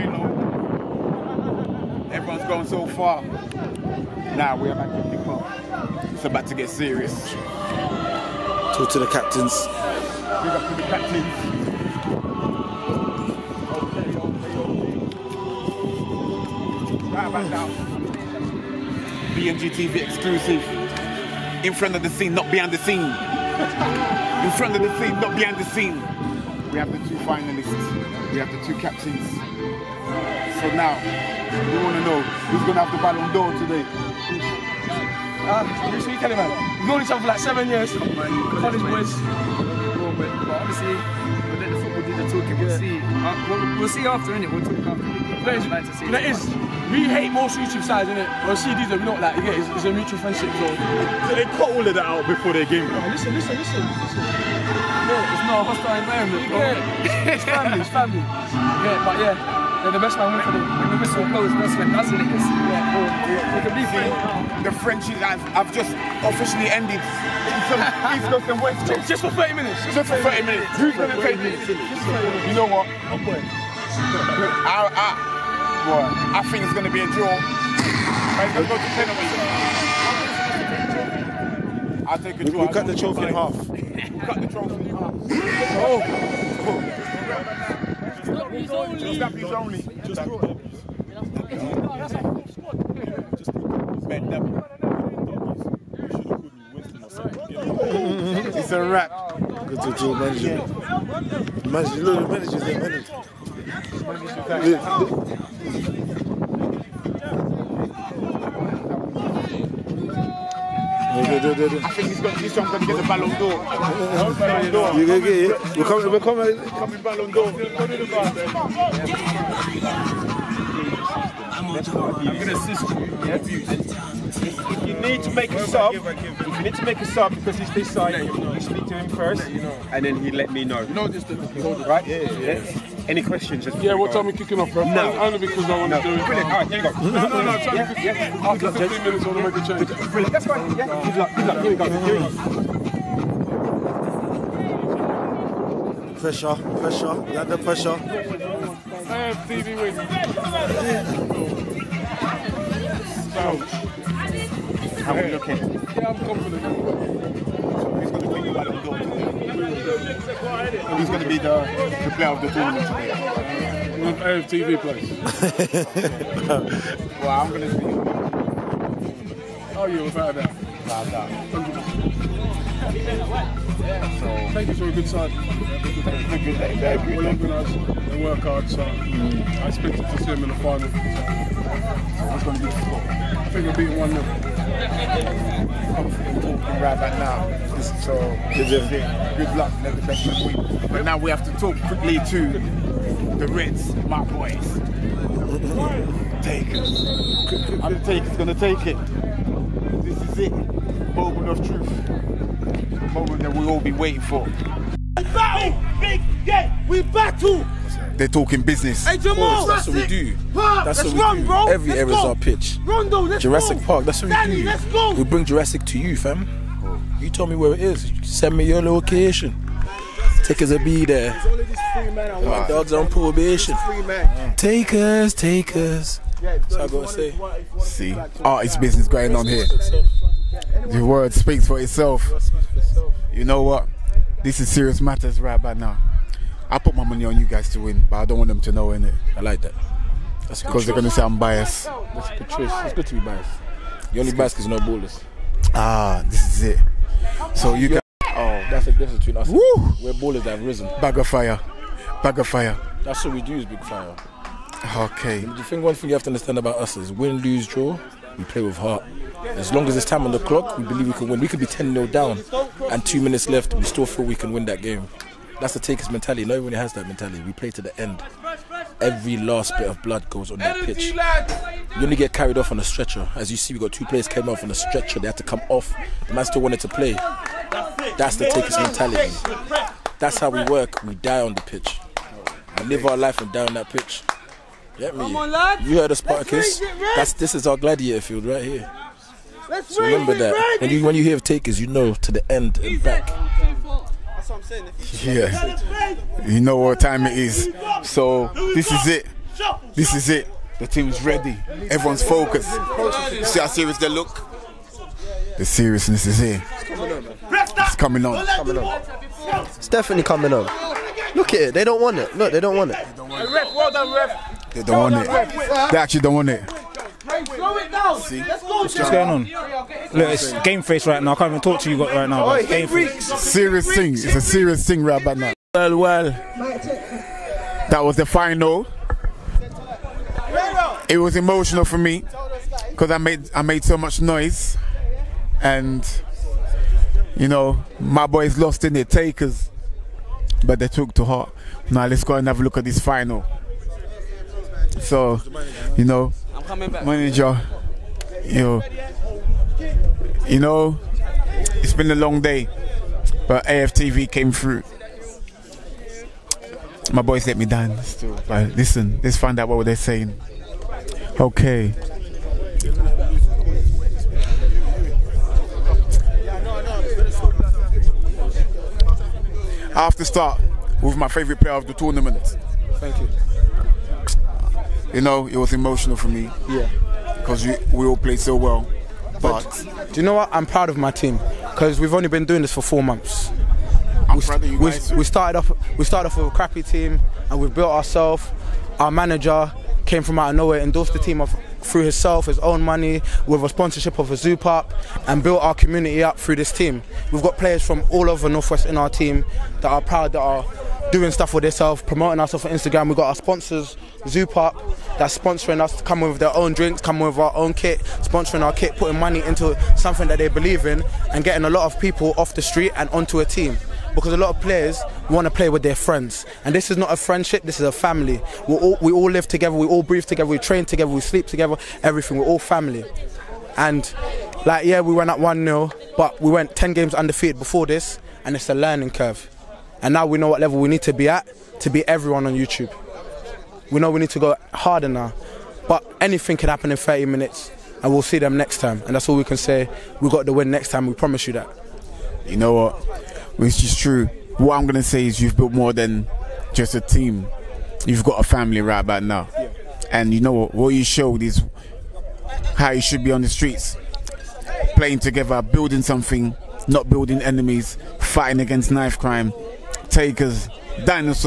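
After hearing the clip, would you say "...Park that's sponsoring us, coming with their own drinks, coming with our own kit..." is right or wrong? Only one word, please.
right.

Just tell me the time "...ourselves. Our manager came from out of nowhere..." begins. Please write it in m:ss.
6:27.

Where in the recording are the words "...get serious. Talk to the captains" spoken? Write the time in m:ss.
0:06.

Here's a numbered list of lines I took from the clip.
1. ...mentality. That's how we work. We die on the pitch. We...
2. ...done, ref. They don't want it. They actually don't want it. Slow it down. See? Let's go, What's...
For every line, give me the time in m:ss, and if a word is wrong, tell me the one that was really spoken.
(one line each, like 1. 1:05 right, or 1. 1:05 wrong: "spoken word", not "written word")
1. 4:38 right
2. 5:13 right.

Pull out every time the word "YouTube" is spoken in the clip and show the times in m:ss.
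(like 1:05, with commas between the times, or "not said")
0:47, 7:12.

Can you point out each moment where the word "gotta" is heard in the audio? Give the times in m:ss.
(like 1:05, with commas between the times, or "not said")
3:46.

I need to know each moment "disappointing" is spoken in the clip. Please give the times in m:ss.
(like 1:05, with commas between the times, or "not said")
not said.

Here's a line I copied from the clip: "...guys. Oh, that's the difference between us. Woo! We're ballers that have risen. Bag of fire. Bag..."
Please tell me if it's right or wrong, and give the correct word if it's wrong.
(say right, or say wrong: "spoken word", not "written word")
right.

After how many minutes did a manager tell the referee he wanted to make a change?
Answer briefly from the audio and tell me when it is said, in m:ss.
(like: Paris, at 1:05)
15, at 2:18.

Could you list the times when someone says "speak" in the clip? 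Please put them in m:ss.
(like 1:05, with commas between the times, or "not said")
2:08, 3:51.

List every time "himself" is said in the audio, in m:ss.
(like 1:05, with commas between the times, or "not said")
6:32.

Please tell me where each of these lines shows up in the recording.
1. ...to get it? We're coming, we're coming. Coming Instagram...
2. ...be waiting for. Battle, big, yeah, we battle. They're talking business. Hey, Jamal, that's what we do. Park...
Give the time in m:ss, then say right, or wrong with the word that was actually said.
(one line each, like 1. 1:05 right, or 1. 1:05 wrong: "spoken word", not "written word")
1. 1:55 wrong: "Ballon", not "Instagram"
2. 3:23 right.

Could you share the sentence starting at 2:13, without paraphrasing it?
Yeah, what time are we kicking off, bro?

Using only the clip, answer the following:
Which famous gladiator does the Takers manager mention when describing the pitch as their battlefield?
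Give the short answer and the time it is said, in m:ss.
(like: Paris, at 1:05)
Spartacus, at 4:46.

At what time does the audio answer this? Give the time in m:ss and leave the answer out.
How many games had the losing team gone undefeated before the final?
7:06.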